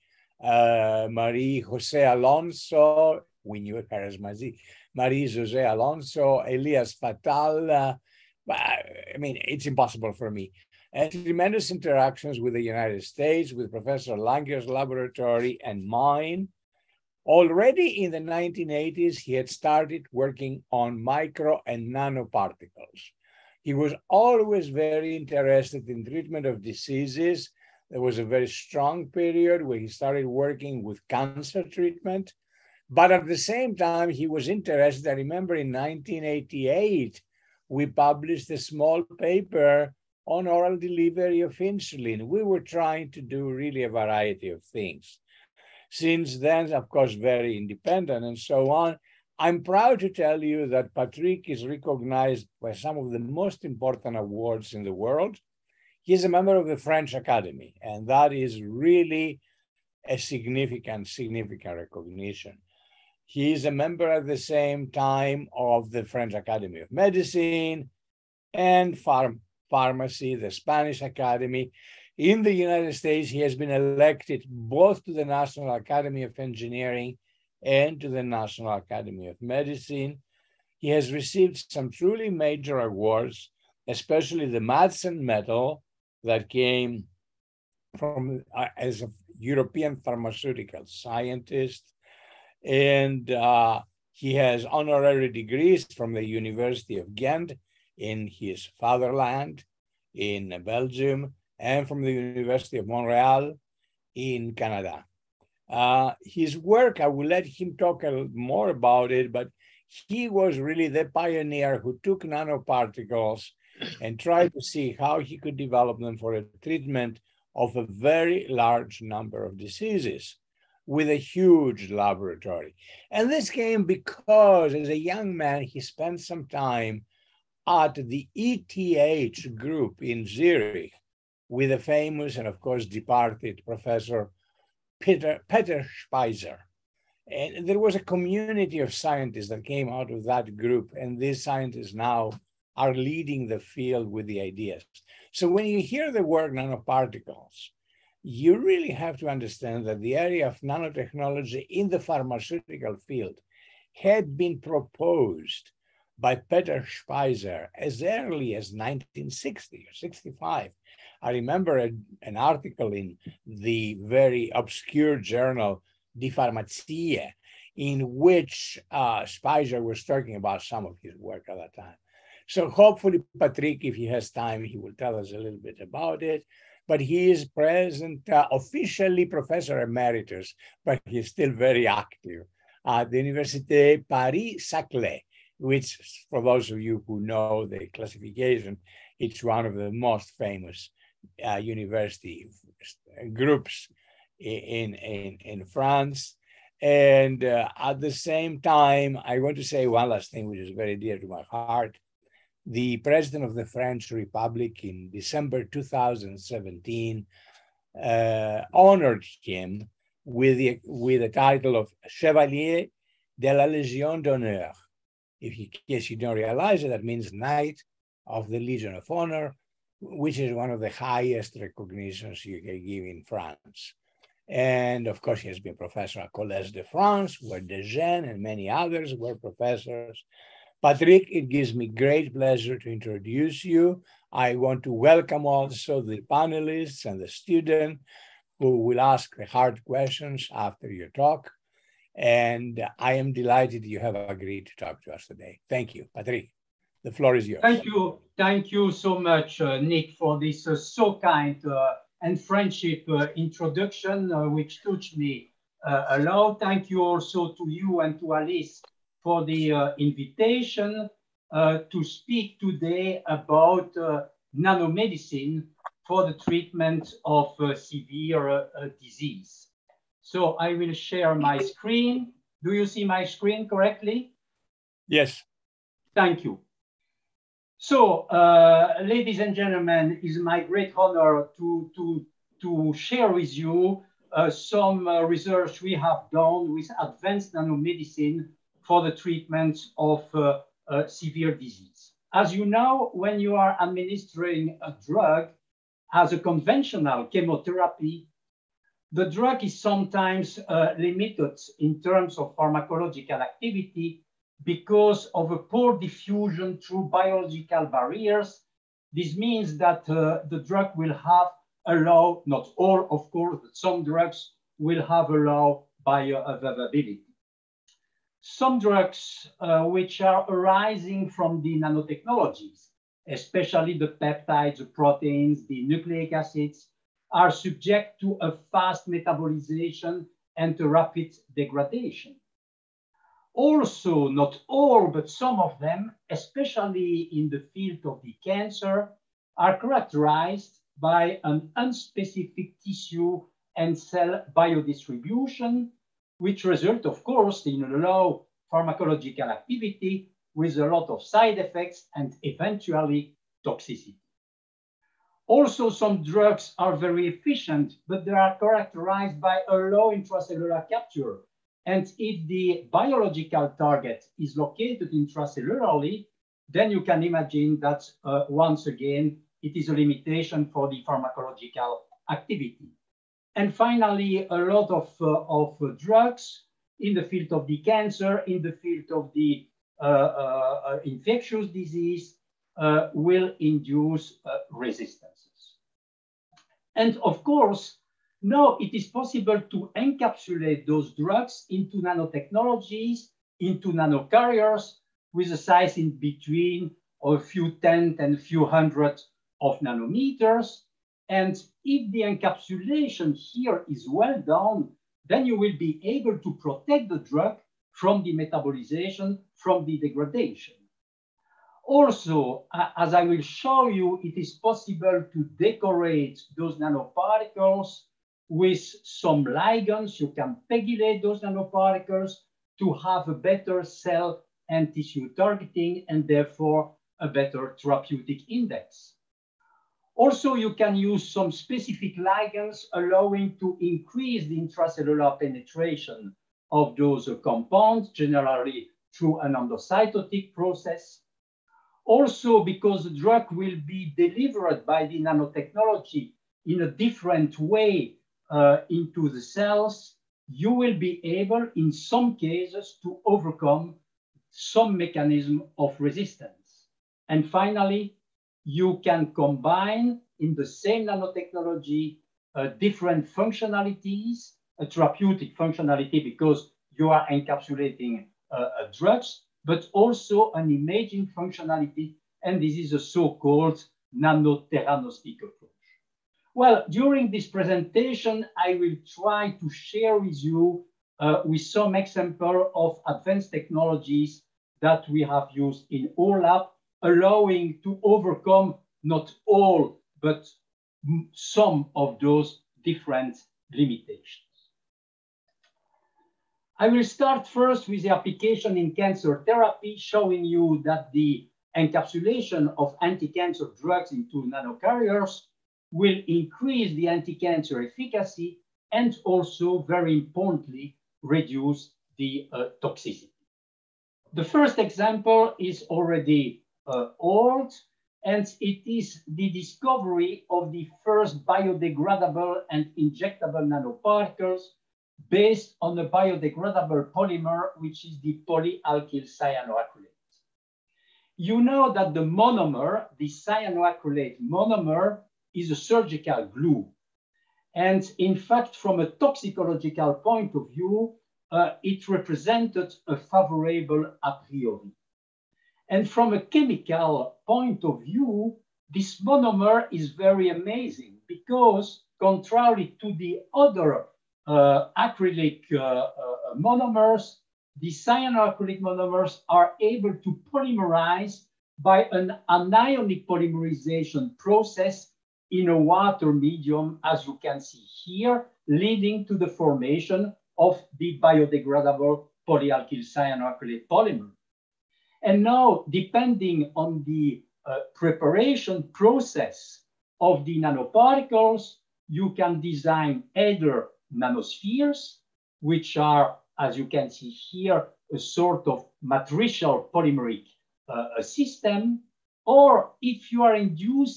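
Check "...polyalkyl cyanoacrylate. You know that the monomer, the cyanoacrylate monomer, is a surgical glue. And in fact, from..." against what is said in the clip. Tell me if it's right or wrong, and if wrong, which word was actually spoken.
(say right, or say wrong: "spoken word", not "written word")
right.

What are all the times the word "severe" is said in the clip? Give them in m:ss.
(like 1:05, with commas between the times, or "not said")
4:27, 4:51.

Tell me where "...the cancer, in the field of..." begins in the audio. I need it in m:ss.
6:17.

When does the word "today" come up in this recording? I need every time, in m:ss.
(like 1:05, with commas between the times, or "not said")
4:05, 4:22.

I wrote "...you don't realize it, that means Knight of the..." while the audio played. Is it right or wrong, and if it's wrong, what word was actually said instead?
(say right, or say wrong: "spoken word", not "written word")
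right.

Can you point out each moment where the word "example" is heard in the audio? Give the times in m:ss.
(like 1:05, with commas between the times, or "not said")
8:01, 8:34.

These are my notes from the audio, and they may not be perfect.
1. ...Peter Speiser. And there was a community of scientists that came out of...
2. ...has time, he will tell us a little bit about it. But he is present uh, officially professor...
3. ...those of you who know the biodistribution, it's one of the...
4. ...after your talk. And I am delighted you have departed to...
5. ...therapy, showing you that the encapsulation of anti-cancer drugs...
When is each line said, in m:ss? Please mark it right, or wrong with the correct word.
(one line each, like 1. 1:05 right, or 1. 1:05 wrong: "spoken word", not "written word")
1. 2:15 right
2. 2:54 right
3. 3:06 wrong: "classification", not "biodistribution"
4. 4:00 wrong: "agreed", not "departed"
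5. 8:19 right.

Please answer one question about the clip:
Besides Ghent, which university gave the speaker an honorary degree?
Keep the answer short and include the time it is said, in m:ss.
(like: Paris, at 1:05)
University of Montreal, at 1:42.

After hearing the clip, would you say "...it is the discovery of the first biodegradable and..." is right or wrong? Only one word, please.
right.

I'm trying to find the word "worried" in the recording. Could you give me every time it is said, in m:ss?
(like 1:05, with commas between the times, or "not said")
not said.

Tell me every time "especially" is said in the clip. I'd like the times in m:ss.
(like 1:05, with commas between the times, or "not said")
1:23, 5:23, 5:36.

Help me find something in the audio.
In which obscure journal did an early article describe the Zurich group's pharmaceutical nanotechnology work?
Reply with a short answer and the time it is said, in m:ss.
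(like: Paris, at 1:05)
Die Pharmazie, at 2:46.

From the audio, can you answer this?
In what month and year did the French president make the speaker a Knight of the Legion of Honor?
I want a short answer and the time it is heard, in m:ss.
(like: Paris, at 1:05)
December 2017, at 3:25.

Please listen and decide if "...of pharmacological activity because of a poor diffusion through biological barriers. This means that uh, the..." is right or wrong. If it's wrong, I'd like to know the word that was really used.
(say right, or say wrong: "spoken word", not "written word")
right.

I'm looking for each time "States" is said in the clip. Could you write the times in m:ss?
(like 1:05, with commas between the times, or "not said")
0:13, 1:12.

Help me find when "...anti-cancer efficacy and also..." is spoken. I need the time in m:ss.
8:27.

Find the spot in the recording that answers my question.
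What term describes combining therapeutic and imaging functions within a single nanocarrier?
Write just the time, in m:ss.
7:54.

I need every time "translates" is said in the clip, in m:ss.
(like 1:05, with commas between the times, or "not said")
not said.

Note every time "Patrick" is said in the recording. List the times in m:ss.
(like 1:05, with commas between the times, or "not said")
0:50, 2:53, 3:50, 4:06.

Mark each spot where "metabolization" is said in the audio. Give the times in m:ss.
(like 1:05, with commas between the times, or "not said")
5:29, 6:48.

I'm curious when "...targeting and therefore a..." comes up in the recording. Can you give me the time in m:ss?
7:05.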